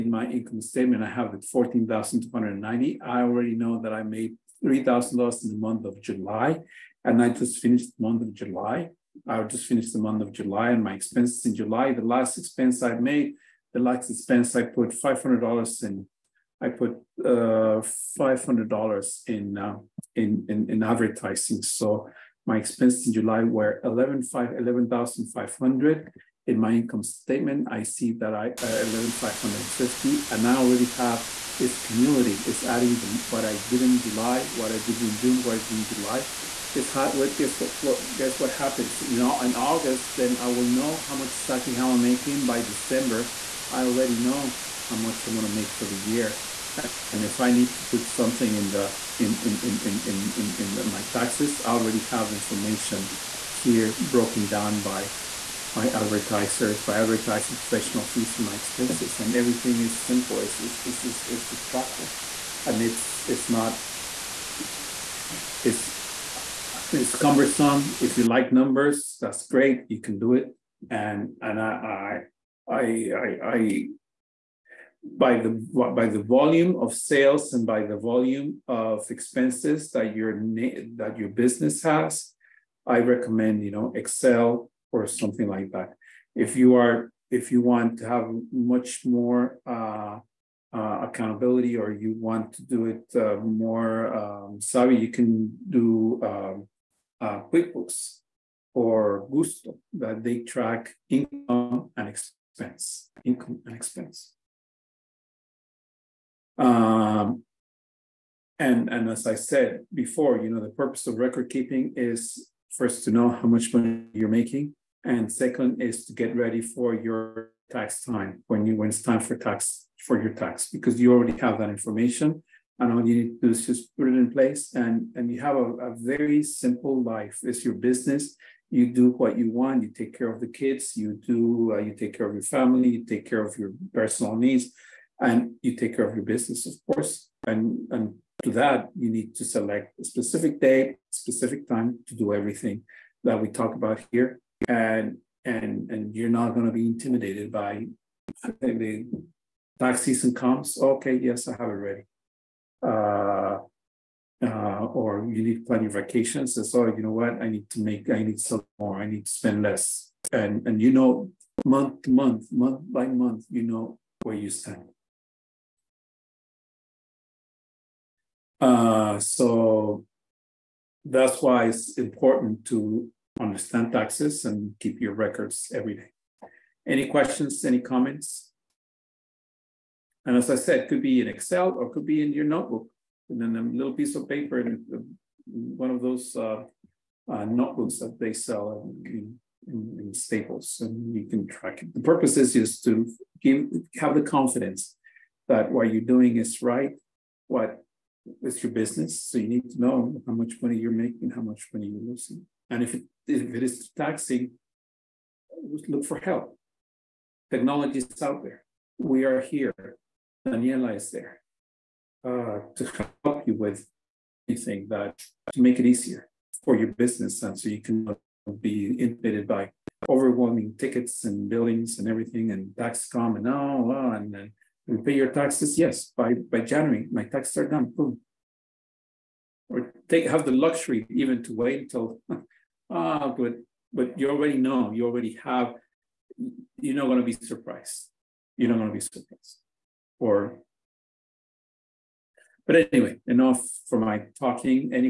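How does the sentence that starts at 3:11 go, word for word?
The purpose is just to give have the confidence that what you're doing is right, what is your business.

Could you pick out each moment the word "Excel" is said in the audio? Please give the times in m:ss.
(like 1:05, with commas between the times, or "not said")
1:23, 3:01.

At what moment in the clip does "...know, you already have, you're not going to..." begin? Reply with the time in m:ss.
3:54.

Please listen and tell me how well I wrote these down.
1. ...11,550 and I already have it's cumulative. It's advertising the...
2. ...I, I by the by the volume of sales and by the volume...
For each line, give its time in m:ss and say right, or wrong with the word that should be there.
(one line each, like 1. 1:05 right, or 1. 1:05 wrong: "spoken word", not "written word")
1. 0:28 wrong: "adding", not "advertising"
2. 1:13 right.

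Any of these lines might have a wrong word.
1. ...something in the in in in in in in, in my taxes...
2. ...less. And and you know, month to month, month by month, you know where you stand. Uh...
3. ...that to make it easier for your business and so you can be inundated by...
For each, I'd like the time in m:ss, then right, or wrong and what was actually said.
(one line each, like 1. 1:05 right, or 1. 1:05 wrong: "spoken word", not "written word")
1. 0:48 right
2. 2:39 right
3. 3:34 right.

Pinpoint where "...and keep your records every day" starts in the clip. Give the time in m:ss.
2:54.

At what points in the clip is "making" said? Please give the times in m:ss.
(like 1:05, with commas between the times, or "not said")
0:42, 1:54, 3:20.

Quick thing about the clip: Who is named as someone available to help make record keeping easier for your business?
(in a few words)
Daniela.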